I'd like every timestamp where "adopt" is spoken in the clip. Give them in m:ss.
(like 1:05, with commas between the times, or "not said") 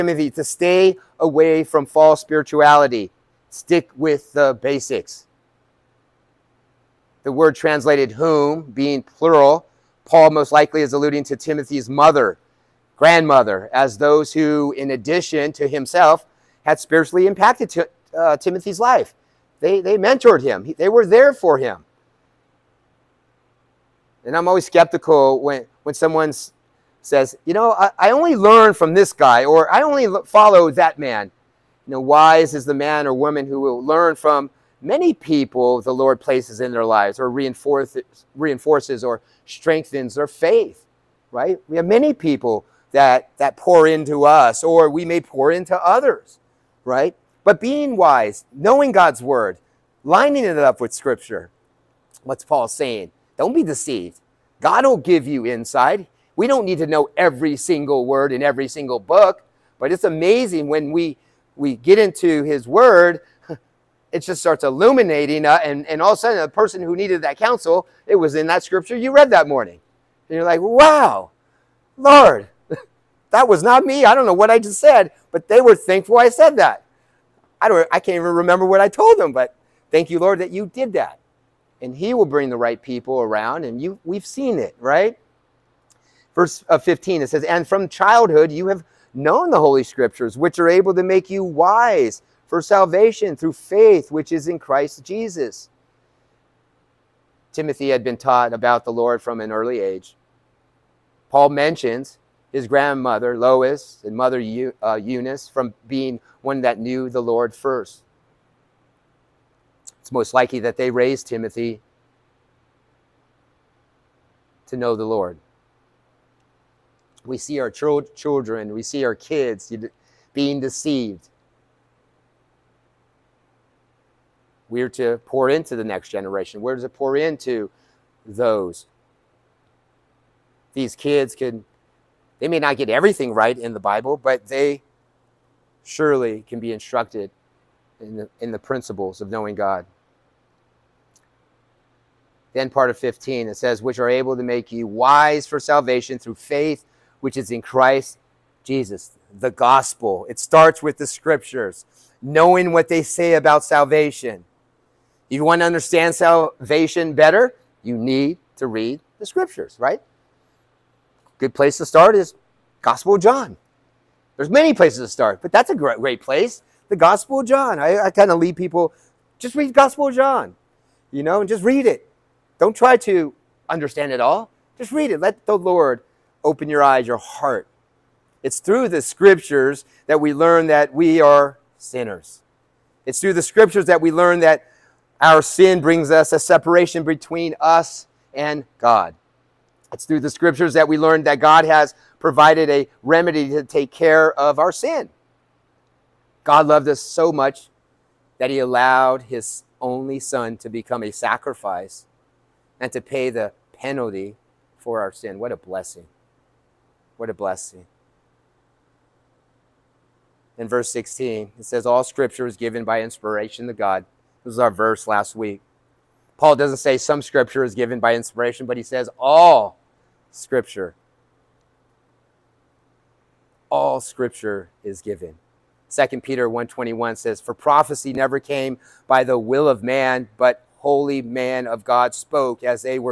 not said.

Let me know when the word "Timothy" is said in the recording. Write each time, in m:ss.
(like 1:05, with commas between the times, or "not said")
0:11, 0:18, 1:37, 1:51.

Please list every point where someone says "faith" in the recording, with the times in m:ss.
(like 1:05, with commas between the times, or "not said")
0:40, 1:33, 2:26.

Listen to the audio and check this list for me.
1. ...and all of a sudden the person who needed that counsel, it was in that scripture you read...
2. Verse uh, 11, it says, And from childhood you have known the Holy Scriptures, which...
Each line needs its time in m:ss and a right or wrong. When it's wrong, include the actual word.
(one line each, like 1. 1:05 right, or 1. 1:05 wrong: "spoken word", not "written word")
1. 1:05 right
2. 1:26 wrong: "15", not "11".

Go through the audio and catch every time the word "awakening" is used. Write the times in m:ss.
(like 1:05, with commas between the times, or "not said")
not said.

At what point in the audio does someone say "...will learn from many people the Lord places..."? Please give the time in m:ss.
0:33.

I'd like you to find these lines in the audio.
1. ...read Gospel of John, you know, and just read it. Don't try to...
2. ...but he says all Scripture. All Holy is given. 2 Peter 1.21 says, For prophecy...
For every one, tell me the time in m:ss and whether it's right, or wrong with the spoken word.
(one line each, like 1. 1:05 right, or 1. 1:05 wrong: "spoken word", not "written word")
1. 2:49 right
2. 3:38 wrong: "Scripture", not "Holy".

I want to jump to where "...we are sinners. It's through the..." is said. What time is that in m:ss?
3:00.